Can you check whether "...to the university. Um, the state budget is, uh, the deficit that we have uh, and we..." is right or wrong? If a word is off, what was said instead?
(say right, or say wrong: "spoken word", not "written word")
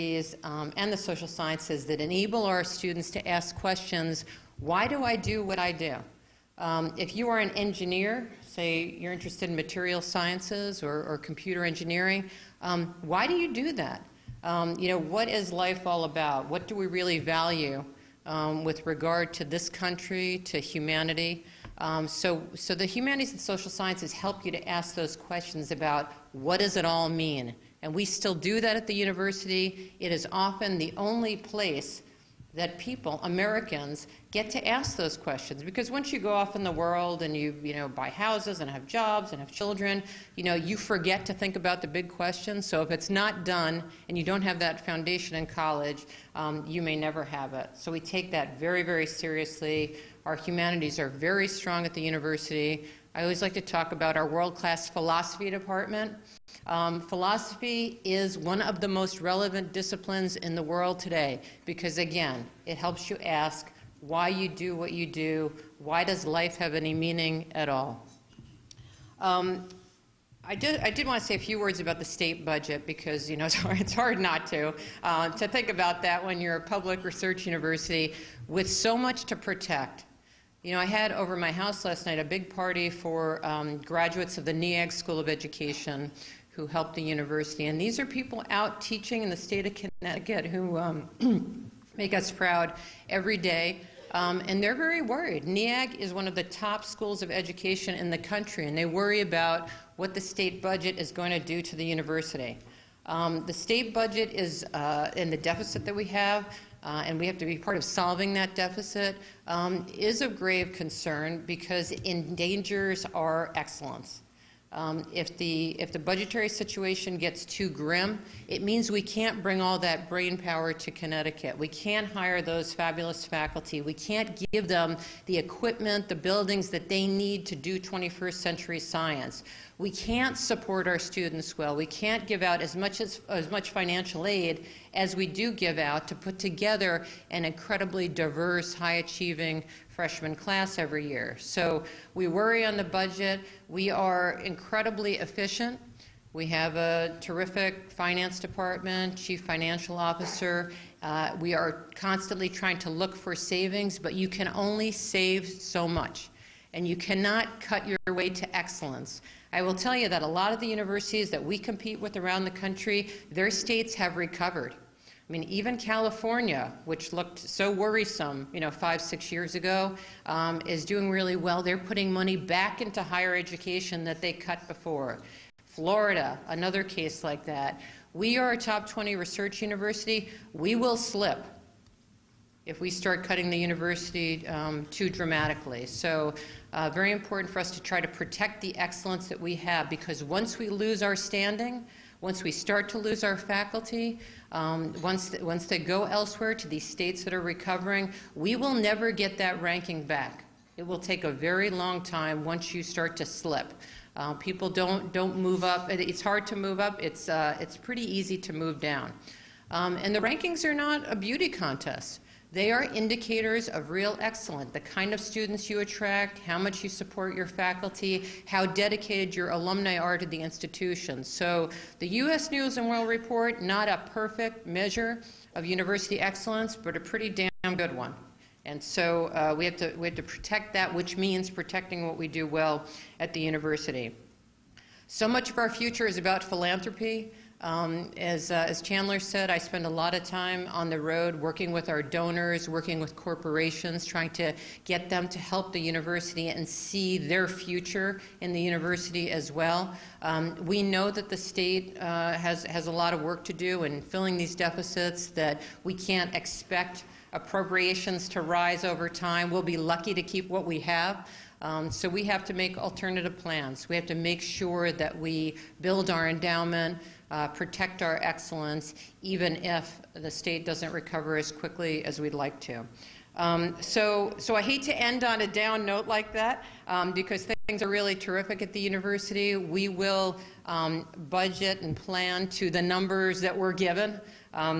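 right.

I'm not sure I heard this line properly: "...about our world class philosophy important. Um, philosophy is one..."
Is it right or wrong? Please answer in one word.
wrong.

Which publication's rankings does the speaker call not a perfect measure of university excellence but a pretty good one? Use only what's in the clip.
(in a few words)
U.S. News and World Report.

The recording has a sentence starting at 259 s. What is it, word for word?
We'll be lucky to keep what we have.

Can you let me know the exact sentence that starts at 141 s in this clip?
So we worry on the budget.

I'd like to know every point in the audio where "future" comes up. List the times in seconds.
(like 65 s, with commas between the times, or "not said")
235 s, 247 s.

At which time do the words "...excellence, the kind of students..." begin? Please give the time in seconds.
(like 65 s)
214 s.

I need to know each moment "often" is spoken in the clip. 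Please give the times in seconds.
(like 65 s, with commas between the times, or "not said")
30 s.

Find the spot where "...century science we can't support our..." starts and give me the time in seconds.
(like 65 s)
128 s.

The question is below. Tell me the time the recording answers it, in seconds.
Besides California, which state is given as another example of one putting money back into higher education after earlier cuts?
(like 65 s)
175 s.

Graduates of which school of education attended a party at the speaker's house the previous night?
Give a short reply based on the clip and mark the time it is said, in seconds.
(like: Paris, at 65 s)
NEAG School of Education, at 84 s.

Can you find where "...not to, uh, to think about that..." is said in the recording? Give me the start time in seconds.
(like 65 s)
74 s.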